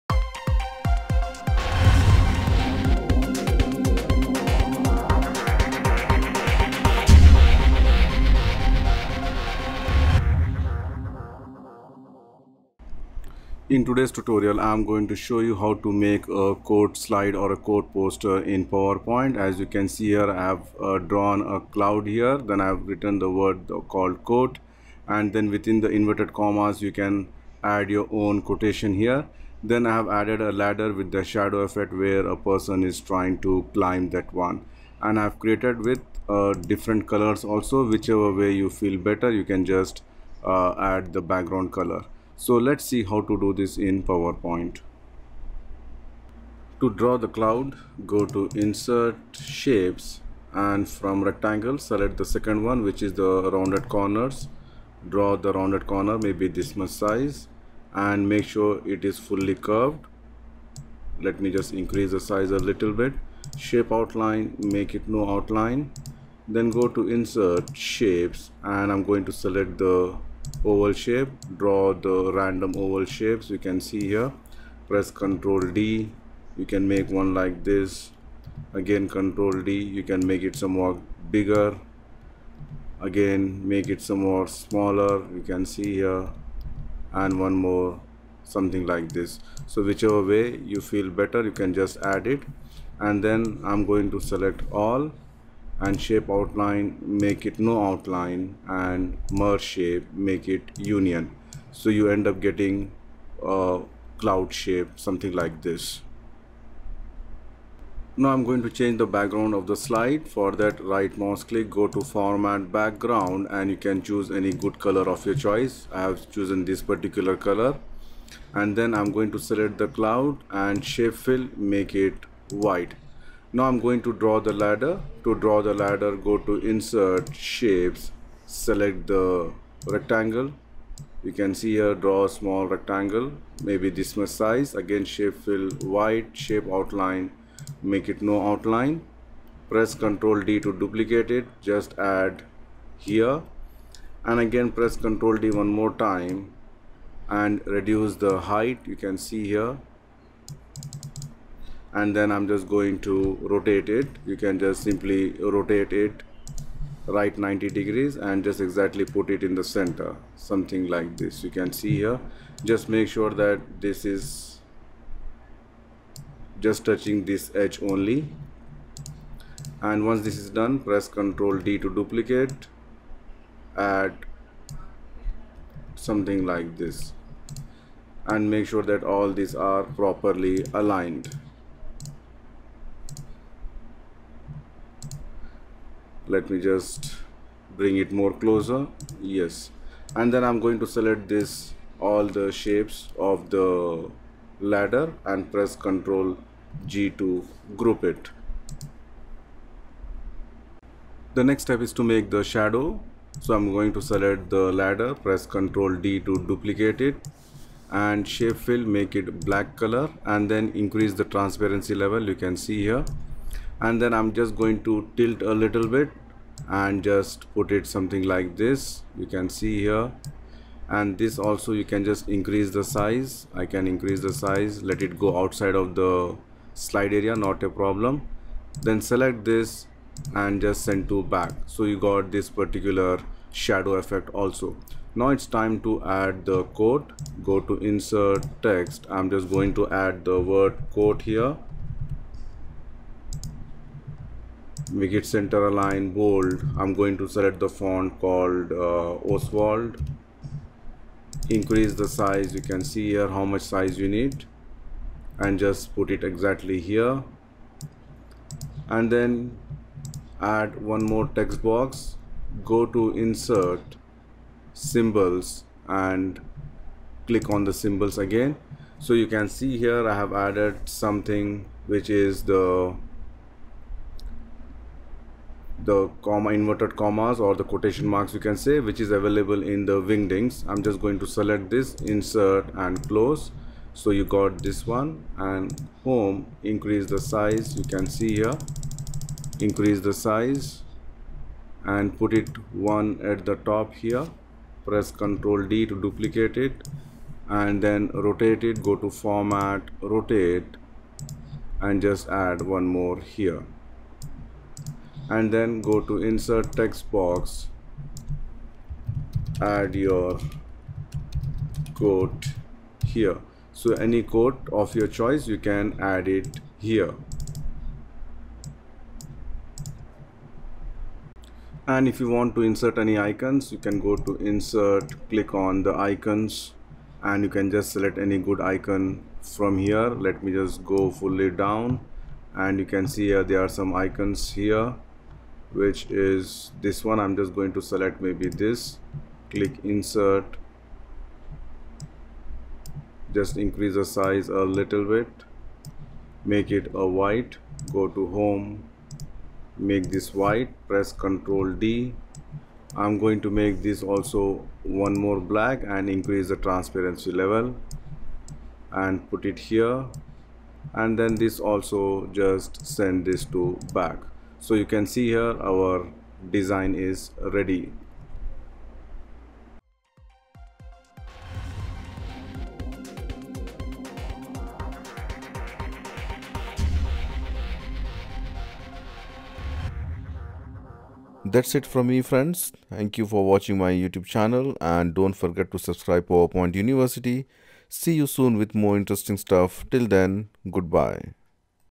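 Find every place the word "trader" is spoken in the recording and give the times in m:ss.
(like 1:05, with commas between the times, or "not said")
not said.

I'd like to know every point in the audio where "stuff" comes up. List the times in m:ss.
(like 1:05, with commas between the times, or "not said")
6:29.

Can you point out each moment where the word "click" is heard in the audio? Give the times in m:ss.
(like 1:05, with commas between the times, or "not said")
1:51, 4:27, 5:25, 5:39.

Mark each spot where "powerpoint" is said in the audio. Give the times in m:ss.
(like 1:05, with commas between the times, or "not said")
0:18, 0:44, 6:26.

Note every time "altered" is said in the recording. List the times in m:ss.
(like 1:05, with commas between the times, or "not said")
not said.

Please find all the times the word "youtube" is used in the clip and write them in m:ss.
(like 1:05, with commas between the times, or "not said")
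6:23.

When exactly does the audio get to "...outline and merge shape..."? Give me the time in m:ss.
1:37.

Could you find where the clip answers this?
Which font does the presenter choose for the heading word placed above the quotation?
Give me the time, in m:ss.
4:09.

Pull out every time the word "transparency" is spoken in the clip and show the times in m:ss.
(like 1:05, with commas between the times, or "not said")
3:31, 5:56.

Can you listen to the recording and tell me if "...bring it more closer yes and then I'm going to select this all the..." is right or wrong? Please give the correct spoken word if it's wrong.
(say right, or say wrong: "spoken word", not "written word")
right.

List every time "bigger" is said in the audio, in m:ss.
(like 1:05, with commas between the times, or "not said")
1:21.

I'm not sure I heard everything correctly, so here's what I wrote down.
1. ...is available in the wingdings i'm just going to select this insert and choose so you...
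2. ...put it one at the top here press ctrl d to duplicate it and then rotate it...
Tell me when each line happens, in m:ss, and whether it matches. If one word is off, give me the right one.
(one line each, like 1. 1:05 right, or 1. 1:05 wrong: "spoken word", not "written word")
1. 4:38 wrong: "close", not "choose"
2. 4:52 right.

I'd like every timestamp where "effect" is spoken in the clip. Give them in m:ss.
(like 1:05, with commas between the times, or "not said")
0:31, 3:53.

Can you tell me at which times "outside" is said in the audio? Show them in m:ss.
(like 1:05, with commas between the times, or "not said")
3:45.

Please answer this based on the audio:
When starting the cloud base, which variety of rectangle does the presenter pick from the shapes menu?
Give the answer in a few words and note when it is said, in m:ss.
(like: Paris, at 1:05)
rounded corners, at 0:53.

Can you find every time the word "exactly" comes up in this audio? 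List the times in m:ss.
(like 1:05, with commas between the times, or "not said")
2:38, 4:16.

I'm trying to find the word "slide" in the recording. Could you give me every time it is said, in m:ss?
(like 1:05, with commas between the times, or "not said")
0:16, 1:49, 3:46.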